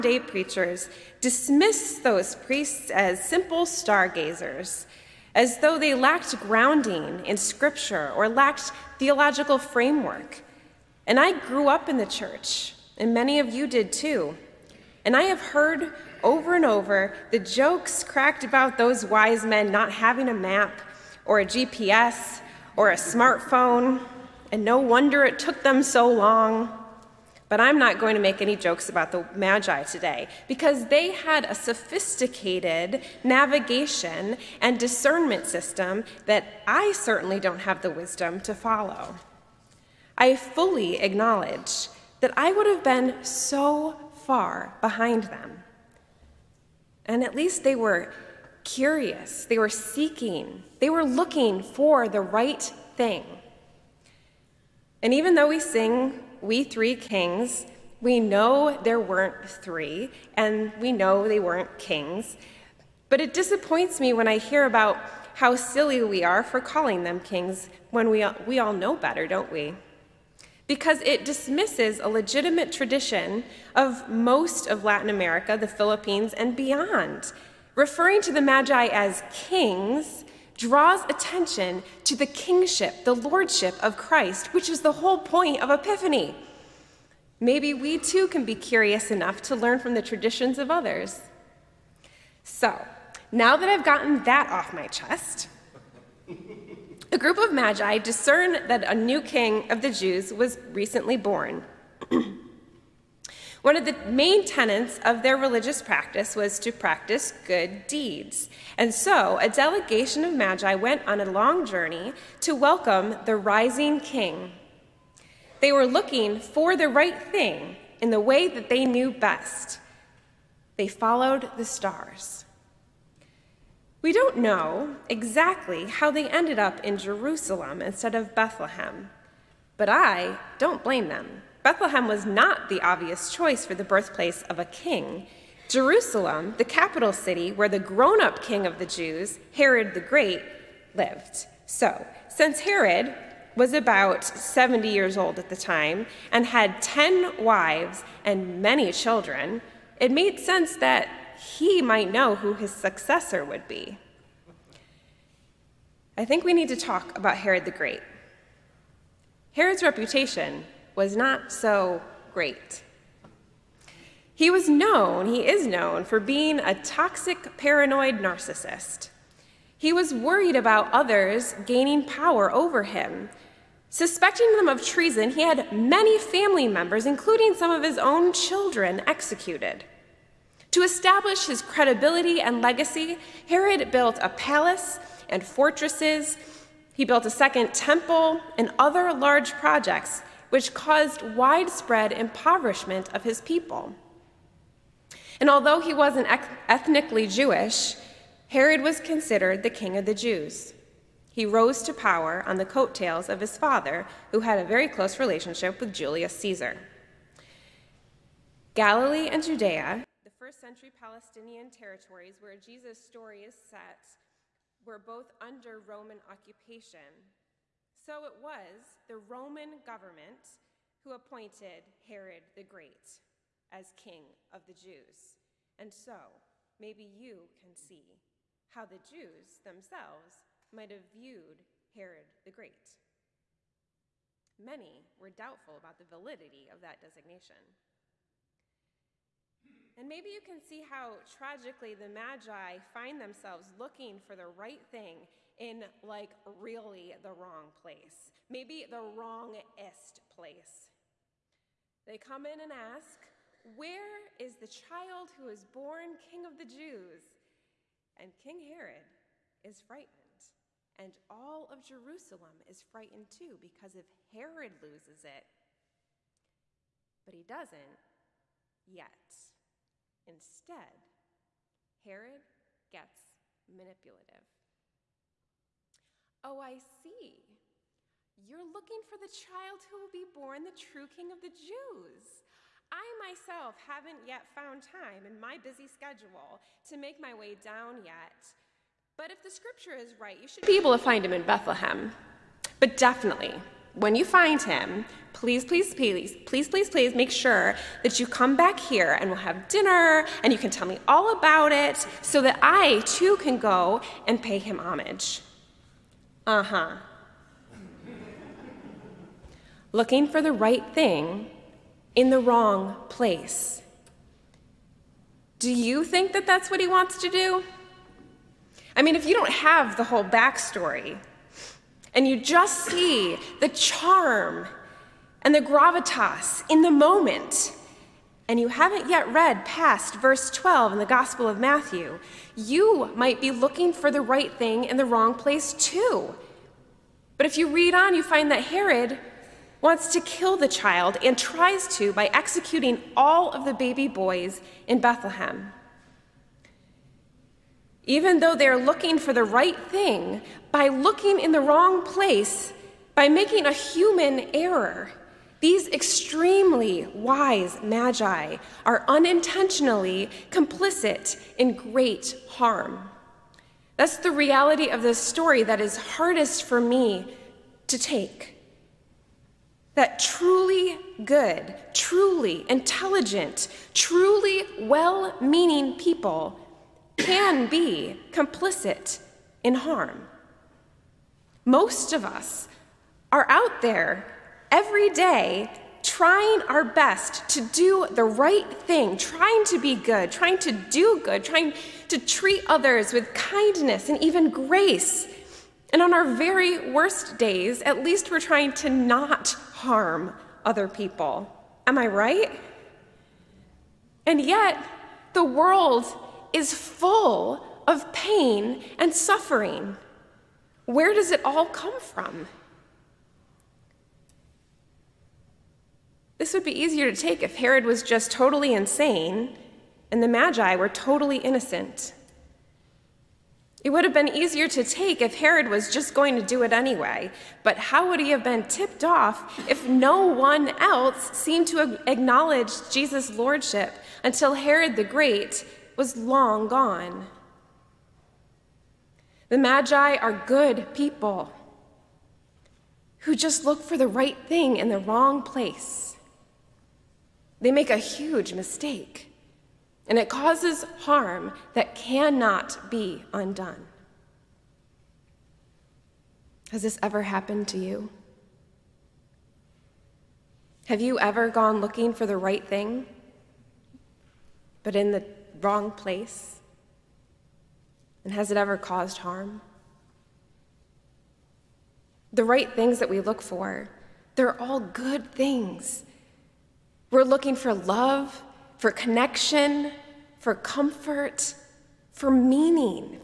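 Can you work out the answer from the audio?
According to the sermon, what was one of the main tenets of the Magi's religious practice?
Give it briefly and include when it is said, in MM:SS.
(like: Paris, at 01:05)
Good deeds, at 01:47.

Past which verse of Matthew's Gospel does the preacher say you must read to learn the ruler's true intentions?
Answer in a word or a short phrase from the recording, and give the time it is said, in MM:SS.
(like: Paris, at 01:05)
Verse 12, at 05:30.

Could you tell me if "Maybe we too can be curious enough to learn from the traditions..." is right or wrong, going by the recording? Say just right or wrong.
right.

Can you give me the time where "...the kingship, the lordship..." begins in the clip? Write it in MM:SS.
01:22.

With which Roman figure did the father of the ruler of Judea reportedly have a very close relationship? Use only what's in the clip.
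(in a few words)
Julius Caesar.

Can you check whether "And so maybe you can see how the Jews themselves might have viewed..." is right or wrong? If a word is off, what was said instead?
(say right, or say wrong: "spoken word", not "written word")
right.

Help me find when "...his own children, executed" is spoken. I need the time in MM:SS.
02:57.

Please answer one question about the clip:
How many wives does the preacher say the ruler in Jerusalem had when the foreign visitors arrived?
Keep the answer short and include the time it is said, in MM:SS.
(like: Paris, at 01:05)
10, at 02:26.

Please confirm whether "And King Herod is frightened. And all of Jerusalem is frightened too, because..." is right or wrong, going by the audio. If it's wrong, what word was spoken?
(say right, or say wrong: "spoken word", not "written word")
right.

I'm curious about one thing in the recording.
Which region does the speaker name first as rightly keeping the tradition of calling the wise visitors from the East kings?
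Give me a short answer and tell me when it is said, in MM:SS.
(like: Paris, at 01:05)
Latin America, at 01:14.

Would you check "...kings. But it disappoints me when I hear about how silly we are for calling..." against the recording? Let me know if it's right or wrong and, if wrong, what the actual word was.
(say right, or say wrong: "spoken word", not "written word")
right.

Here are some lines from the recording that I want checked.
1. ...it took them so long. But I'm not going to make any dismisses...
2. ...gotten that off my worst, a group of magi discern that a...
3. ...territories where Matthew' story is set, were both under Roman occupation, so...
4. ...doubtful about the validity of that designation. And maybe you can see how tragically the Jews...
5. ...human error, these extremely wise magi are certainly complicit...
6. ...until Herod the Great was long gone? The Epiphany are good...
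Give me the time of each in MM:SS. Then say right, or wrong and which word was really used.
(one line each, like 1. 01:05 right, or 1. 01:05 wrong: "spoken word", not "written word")
1. 00:25 wrong: "jokes", not "dismisses"
2. 01:33 wrong: "chest", not "worst"
3. 03:31 wrong: "Jesus", not "Matthew"
4. 03:55 wrong: "Magi", not "Jews"
5. 05:53 wrong: "unintentionally", not "certainly"
6. 07:14 wrong: "Magi", not "Epiphany".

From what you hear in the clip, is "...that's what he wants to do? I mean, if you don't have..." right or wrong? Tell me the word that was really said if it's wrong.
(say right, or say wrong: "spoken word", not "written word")
right.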